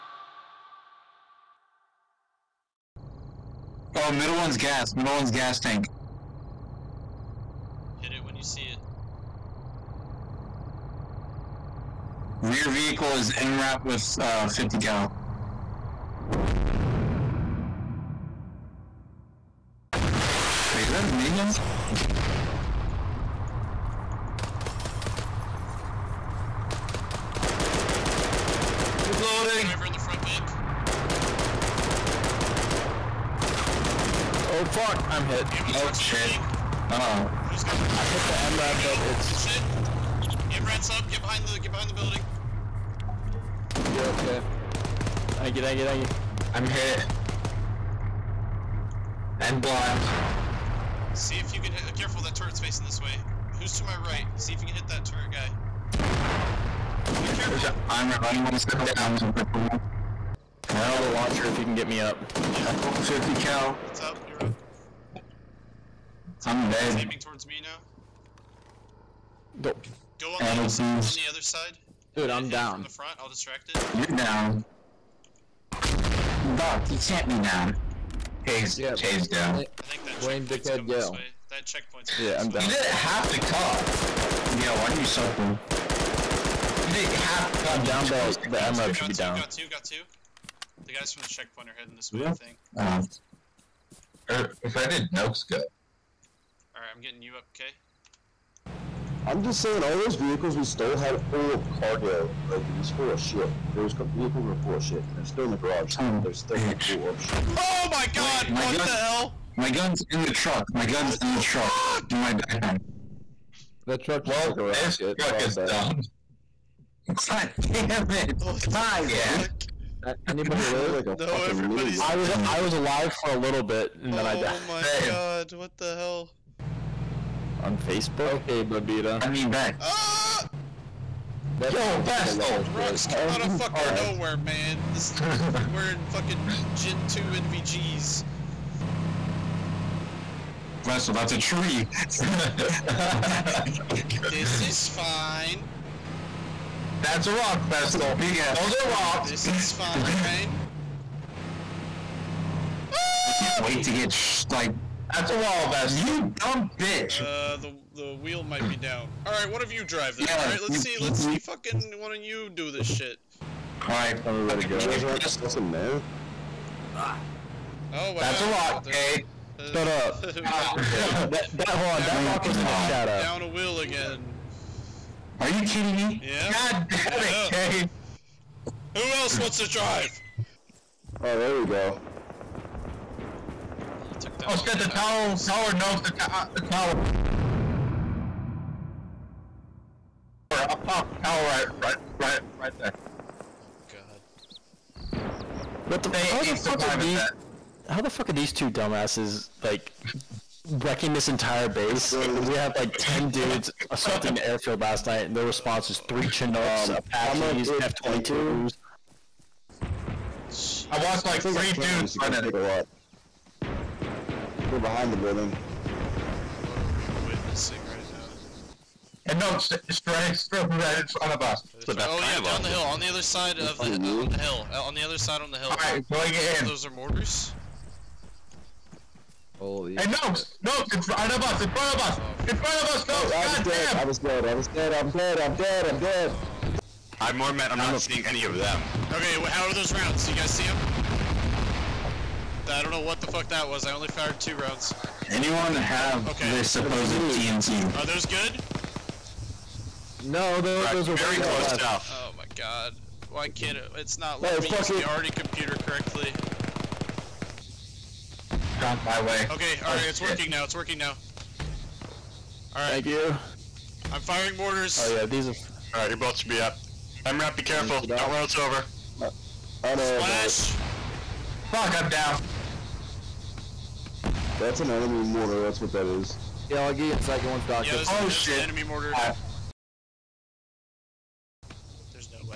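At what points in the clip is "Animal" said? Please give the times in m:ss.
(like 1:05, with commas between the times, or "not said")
1:10.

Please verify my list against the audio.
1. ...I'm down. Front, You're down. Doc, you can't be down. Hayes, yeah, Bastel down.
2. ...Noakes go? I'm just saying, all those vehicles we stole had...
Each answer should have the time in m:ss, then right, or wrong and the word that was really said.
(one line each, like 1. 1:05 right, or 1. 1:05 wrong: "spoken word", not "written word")
1. 1:12 wrong: "Hayes", not "Bastel"
2. 1:35 right.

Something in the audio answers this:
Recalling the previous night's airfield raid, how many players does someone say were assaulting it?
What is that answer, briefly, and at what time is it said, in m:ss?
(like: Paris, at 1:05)
10, at 3:22.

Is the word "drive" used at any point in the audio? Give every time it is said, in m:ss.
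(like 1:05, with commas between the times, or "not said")
2:39, 2:59.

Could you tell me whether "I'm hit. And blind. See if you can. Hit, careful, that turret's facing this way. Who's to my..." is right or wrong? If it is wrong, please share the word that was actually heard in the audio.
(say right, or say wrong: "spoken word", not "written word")
right.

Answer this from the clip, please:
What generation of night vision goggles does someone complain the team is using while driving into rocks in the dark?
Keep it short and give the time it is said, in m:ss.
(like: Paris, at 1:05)
Gen 2, at 2:16.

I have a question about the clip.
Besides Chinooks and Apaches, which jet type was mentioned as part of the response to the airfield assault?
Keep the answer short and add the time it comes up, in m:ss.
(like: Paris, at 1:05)
F-22s, at 3:27.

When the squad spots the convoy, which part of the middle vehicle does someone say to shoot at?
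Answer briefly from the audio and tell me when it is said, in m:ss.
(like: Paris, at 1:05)
Gas tank, at 0:05.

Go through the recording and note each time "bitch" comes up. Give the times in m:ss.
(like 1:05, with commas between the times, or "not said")
1:46, 2:36.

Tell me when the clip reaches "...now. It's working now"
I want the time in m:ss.
4:20.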